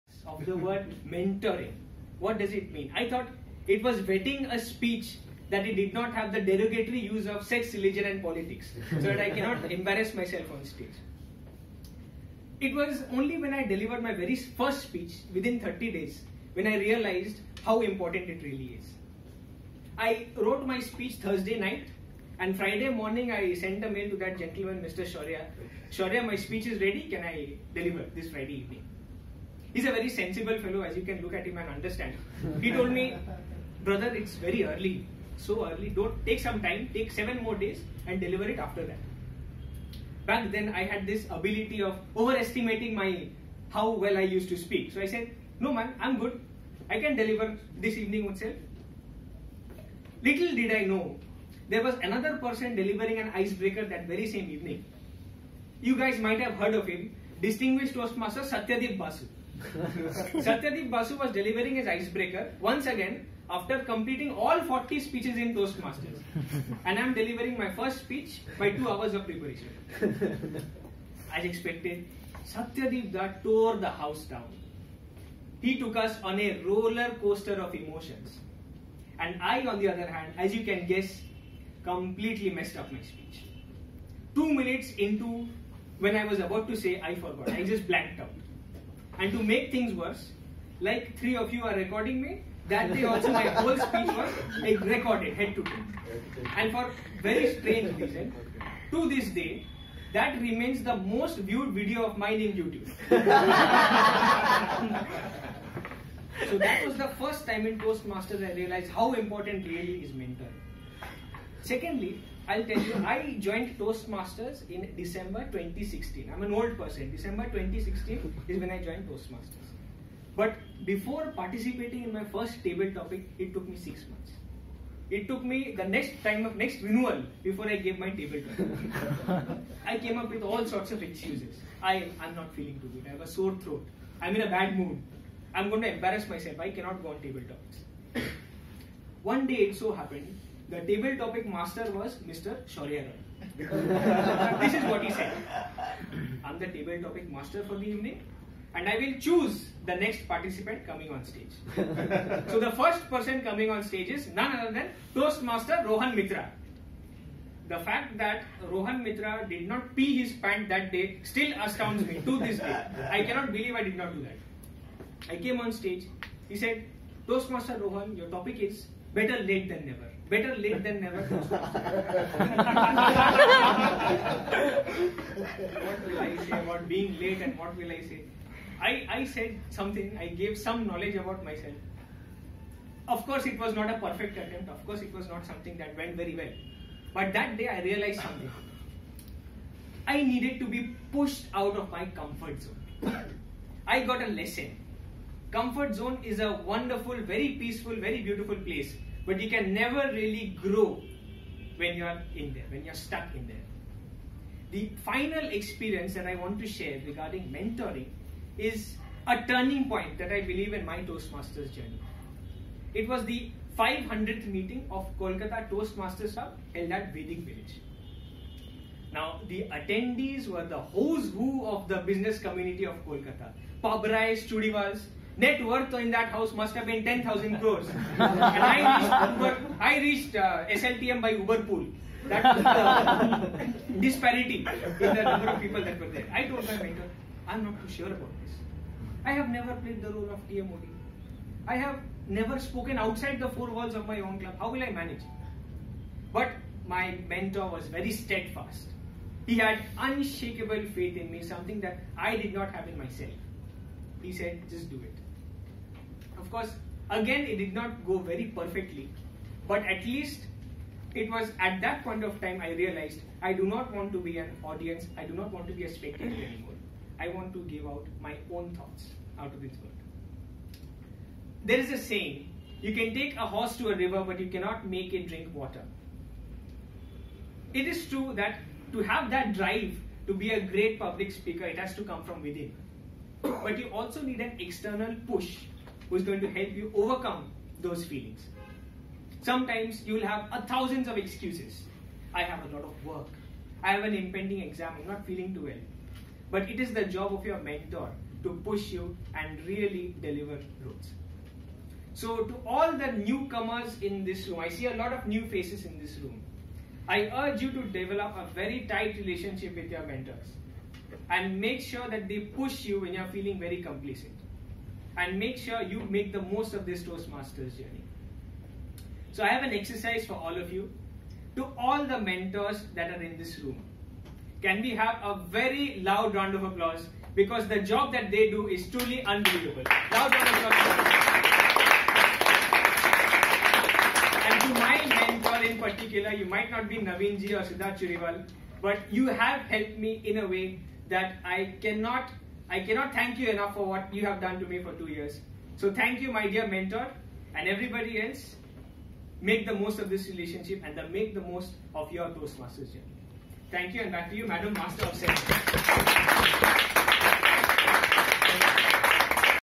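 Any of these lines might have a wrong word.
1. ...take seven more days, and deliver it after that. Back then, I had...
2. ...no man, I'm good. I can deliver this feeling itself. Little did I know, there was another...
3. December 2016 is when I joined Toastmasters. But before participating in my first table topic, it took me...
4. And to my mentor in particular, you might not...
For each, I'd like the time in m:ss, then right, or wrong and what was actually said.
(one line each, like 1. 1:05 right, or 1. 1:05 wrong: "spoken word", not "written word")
1. 0:36 right
2. 0:45 wrong: "evening", not "feeling"
3. 1:57 right
4. 5:34 right.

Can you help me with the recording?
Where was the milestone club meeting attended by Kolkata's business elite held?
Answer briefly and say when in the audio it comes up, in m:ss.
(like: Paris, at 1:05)
Vedic Village, at 3:37.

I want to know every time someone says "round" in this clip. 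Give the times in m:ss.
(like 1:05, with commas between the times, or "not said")
5:26, 5:30.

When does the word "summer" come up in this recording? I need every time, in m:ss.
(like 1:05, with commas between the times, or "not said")
not said.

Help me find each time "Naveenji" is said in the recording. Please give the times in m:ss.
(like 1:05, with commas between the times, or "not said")
5:36.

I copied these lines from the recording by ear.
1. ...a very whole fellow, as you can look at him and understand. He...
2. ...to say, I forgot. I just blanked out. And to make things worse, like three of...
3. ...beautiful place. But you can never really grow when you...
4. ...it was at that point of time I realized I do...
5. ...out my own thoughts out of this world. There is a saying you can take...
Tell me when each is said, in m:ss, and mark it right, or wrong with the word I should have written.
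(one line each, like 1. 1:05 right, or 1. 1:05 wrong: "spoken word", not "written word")
1. 0:29 wrong: "sensible", not "whole"
2. 1:26 right
3. 3:18 right
4. 4:21 right
5. 4:27 right.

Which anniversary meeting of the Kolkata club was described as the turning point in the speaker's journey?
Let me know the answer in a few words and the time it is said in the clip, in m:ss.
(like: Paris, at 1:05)
500th meeting, at 3:33.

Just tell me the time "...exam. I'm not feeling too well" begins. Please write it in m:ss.
4:54.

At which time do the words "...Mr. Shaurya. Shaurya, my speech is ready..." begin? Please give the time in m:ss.
0:24.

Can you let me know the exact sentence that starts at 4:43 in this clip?
But you also need an external push who is going to help you overcome those feelings.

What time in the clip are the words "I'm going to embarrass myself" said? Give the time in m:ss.
2:15.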